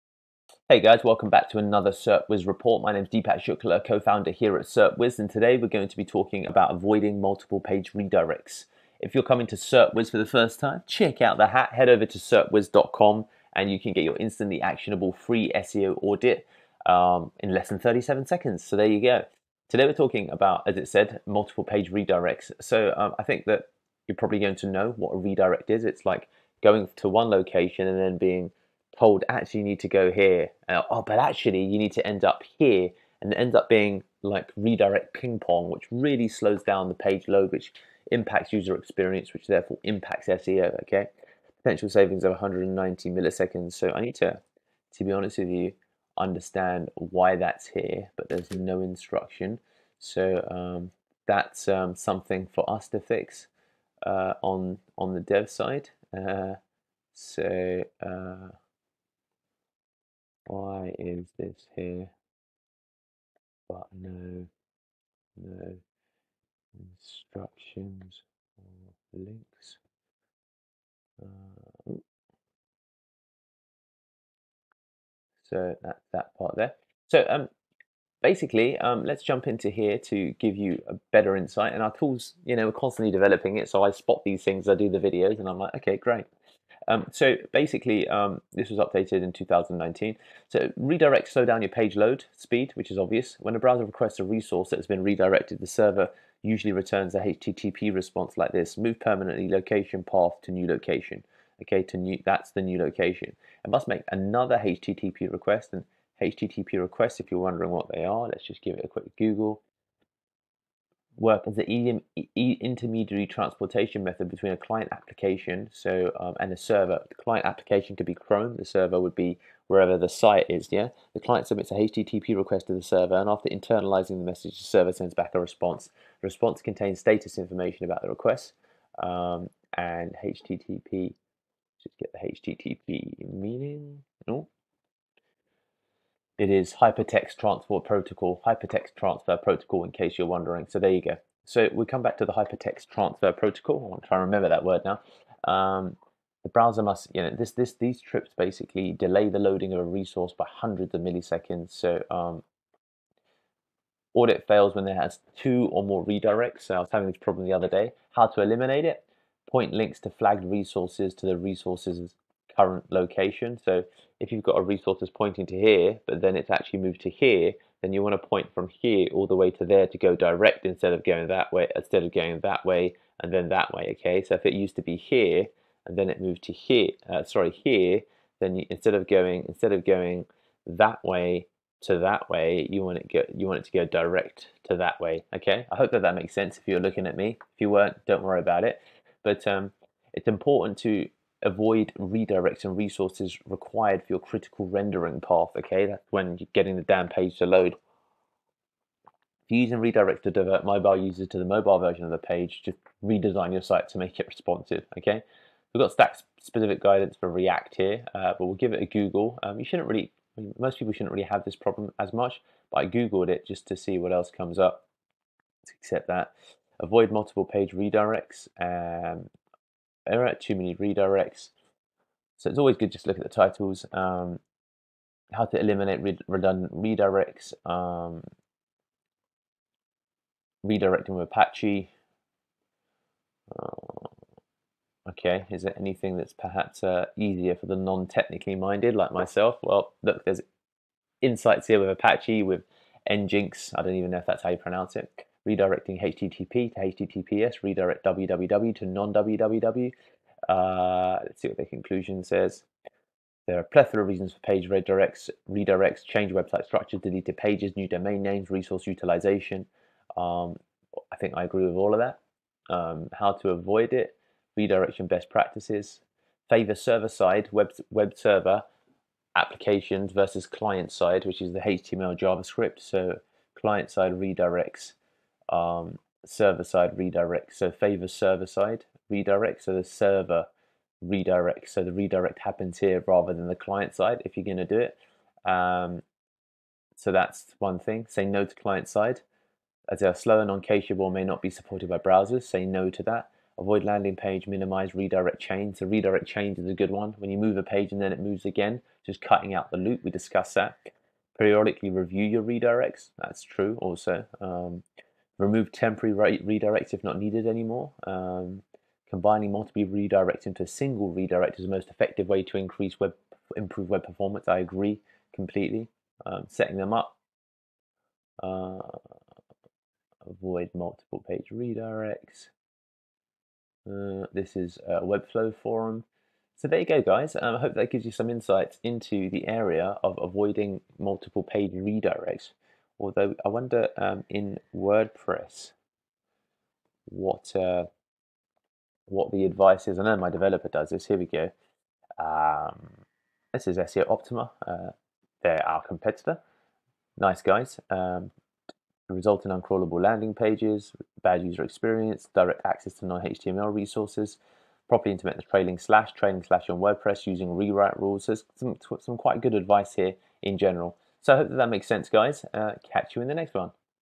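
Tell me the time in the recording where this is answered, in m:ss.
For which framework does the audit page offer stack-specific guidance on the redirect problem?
3:27.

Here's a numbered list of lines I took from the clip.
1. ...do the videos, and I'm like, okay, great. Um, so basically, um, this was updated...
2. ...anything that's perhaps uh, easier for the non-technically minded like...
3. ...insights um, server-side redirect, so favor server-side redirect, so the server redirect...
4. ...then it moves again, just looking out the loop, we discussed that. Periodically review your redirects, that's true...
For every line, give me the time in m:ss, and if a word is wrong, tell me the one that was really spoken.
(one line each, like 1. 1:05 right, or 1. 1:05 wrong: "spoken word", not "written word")
1. 1:24 right
2. 3:55 right
3. 4:34 wrong: "redirects", not "insights"
4. 4:58 wrong: "cutting", not "looking".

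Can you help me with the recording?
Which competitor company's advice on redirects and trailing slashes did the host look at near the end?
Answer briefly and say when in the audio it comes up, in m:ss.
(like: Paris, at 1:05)
SEOptimer, at 5:43.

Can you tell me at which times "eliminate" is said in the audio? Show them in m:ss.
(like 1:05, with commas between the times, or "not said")
2:38, 3:45.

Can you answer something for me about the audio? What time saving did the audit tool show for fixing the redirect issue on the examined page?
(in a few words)
190 milliseconds.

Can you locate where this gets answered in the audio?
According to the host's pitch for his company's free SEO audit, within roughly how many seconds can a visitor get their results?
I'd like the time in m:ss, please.
0:17.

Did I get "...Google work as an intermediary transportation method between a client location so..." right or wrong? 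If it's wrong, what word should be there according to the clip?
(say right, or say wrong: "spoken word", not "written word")
wrong: "application", not "location".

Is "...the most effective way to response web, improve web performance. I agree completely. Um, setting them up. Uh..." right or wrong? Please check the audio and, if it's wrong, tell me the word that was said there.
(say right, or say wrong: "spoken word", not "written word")
wrong: "increase", not "response".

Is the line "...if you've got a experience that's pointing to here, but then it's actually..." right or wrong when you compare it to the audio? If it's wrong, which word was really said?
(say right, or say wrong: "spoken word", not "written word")
wrong: "resource", not "experience".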